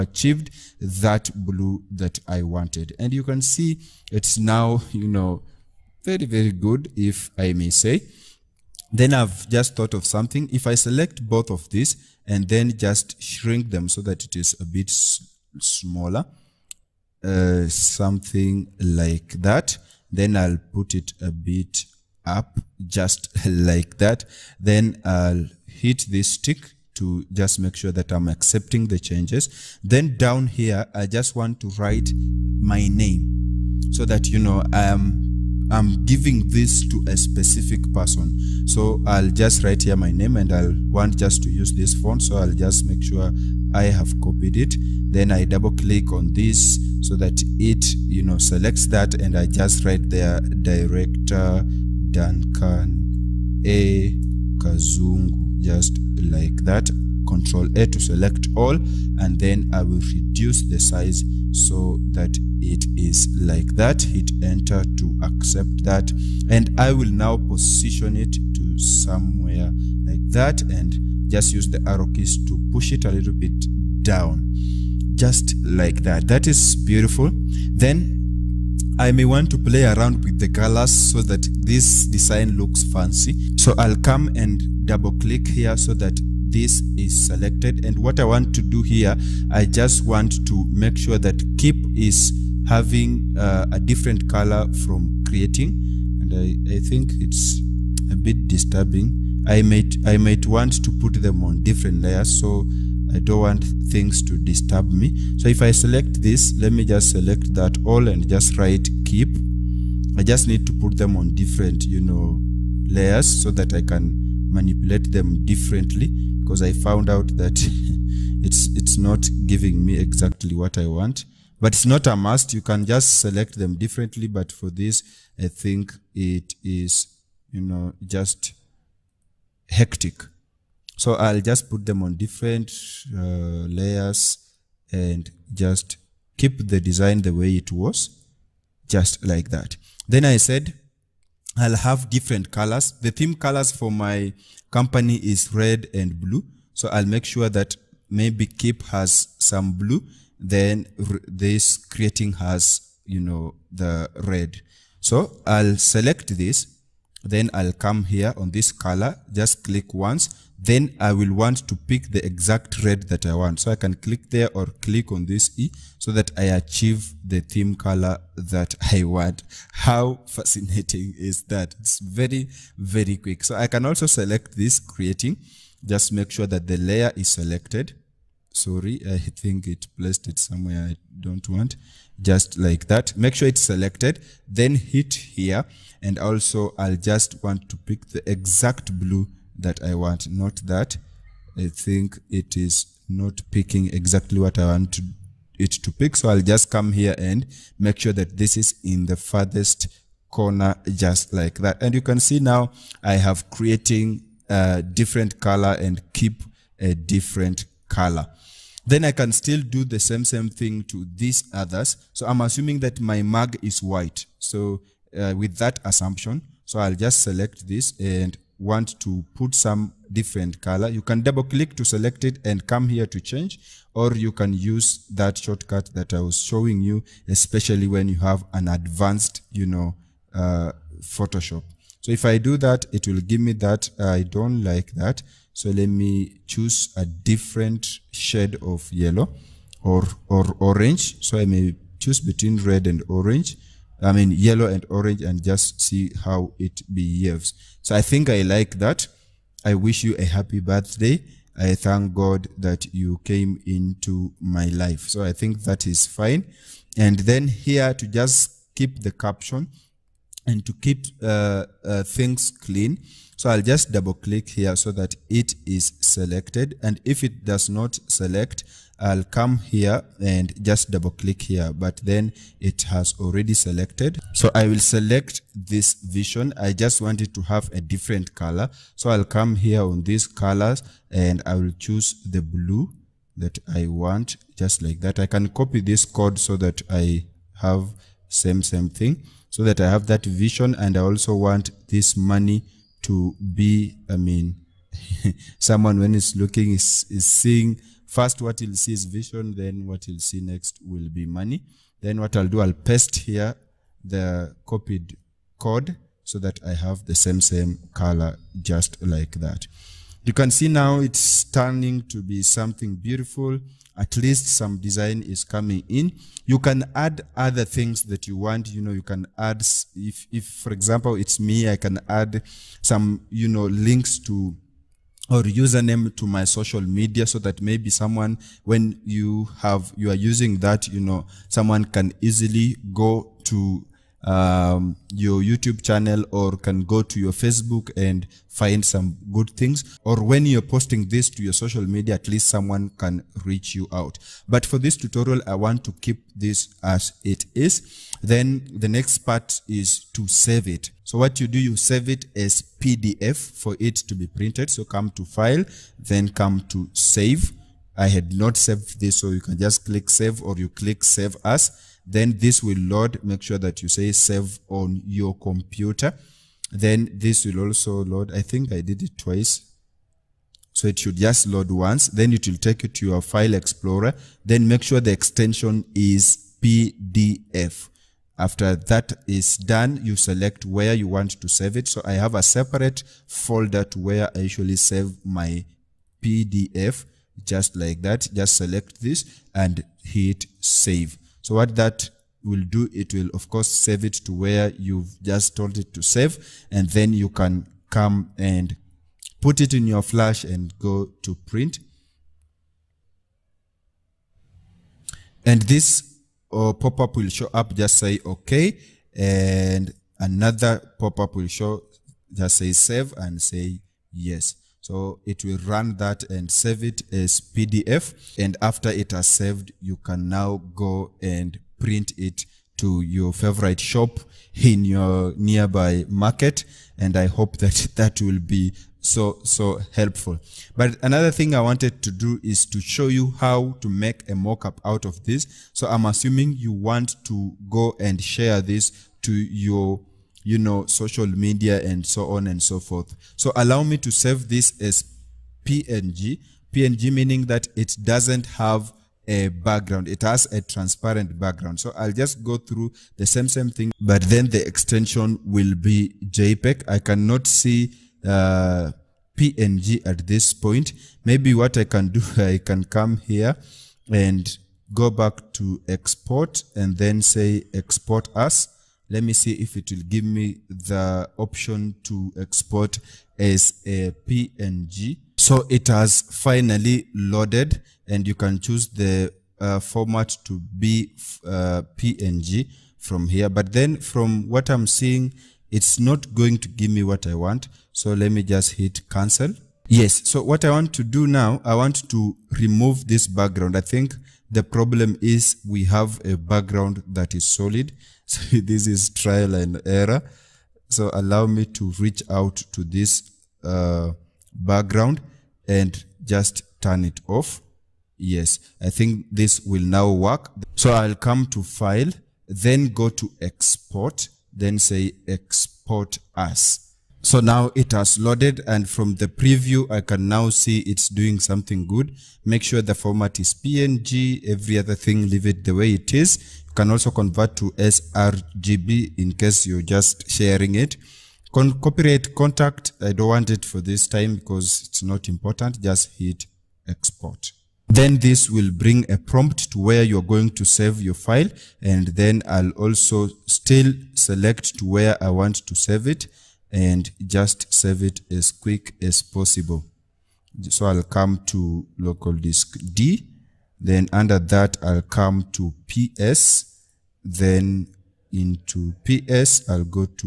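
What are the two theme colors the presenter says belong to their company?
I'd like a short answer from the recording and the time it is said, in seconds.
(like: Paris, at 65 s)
Red and blue, at 145 s.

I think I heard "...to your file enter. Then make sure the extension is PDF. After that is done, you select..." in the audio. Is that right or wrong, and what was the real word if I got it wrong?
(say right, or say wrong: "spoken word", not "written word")
wrong: "explorer", not "enter".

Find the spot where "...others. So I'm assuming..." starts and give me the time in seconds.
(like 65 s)
211 s.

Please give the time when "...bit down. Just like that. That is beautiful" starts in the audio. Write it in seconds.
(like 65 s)
73 s.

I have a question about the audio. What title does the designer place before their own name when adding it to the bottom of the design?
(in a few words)
Director.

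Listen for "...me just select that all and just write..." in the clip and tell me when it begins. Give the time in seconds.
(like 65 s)
106 s.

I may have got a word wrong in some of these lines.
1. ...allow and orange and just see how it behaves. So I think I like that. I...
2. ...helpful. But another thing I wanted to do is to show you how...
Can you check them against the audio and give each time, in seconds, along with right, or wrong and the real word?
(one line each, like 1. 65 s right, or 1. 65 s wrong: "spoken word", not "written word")
1. 244 s wrong: "yellow", not "allow"
2. 429 s right.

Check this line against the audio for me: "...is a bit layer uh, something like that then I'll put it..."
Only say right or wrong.
wrong.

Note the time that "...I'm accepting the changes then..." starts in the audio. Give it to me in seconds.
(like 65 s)
28 s.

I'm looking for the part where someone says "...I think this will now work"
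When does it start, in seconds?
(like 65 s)
508 s.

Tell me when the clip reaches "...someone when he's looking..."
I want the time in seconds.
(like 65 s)
295 s.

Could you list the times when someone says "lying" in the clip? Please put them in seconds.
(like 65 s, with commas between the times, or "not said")
not said.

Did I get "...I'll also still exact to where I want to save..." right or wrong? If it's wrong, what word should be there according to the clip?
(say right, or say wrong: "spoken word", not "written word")
wrong: "select", not "exact".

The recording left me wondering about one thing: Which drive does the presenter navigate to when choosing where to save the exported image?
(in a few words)
Local disk D.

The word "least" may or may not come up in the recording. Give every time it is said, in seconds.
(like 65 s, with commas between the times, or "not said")
314 s, 342 s.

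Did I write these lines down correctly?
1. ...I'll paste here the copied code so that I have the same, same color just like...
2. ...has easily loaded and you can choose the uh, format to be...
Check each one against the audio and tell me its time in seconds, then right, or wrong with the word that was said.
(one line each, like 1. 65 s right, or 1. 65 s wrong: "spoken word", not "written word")
1. 302 s right
2. 475 s wrong: "finally", not "easily".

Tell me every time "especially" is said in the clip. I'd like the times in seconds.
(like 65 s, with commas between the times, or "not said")
227 s.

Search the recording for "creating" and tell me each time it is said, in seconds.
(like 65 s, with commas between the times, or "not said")
95 s, 151 s, 174 s, 203 s.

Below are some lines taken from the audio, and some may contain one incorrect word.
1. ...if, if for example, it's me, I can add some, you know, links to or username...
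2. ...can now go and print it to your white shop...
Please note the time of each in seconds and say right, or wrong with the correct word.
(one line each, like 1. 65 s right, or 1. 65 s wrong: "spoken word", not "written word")
1. 319 s right
2. 419 s wrong: "favorite", not "white".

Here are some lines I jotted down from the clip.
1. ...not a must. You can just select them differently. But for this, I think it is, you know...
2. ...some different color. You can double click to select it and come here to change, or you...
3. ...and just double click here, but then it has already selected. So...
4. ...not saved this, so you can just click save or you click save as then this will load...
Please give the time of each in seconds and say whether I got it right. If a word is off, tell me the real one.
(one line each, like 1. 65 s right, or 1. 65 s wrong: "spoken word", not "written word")
1. 121 s right
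2. 219 s right
3. 270 s right
4. 358 s right.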